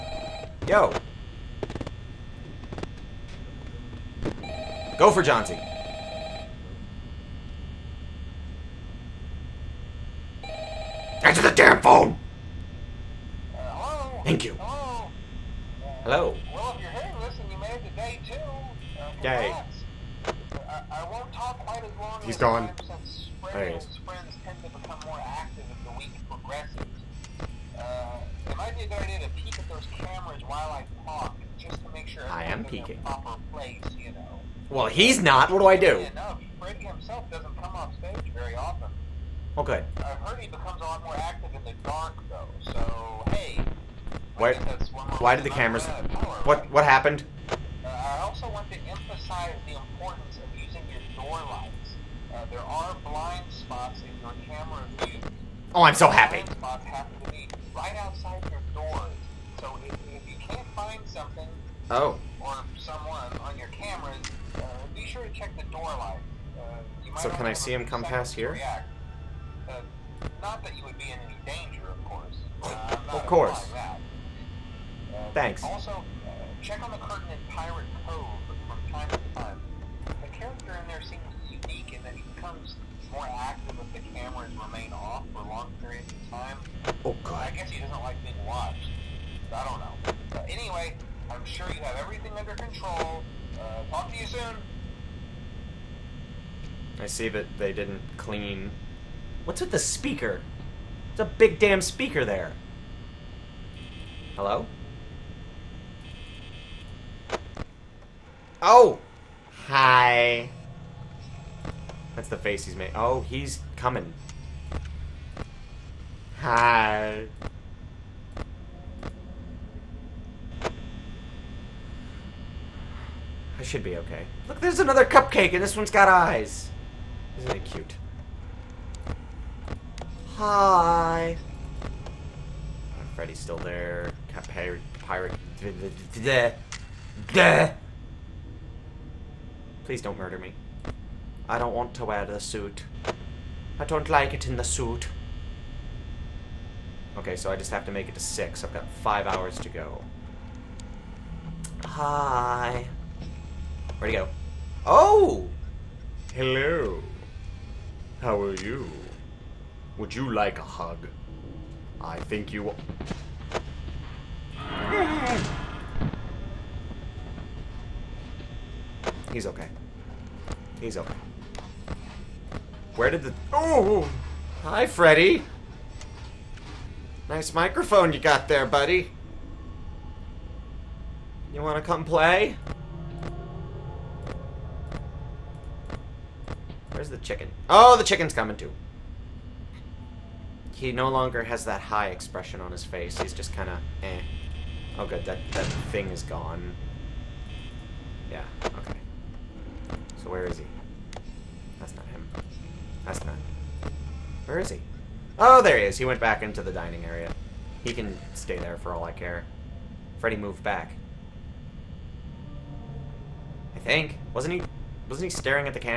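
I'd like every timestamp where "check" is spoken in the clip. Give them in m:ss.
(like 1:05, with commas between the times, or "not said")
1:05, 1:16.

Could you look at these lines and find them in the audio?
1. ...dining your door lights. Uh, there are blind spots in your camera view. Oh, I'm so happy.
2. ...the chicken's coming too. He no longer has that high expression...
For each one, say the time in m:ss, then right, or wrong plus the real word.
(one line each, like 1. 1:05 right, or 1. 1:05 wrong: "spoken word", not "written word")
1. 0:50 wrong: "using", not "dining"
2. 3:07 right.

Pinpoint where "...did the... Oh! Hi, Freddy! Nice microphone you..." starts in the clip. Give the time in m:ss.
2:53.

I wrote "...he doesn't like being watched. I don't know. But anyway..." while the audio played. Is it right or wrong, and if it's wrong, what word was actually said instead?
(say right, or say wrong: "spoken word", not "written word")
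right.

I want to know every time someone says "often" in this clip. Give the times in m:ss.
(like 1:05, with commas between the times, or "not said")
0:38.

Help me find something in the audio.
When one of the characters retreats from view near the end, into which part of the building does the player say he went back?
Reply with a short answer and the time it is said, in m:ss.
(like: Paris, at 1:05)
the dining area, at 3:26.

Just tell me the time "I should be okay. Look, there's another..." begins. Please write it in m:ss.
2:03.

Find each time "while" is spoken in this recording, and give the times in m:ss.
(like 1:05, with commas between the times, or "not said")
0:30.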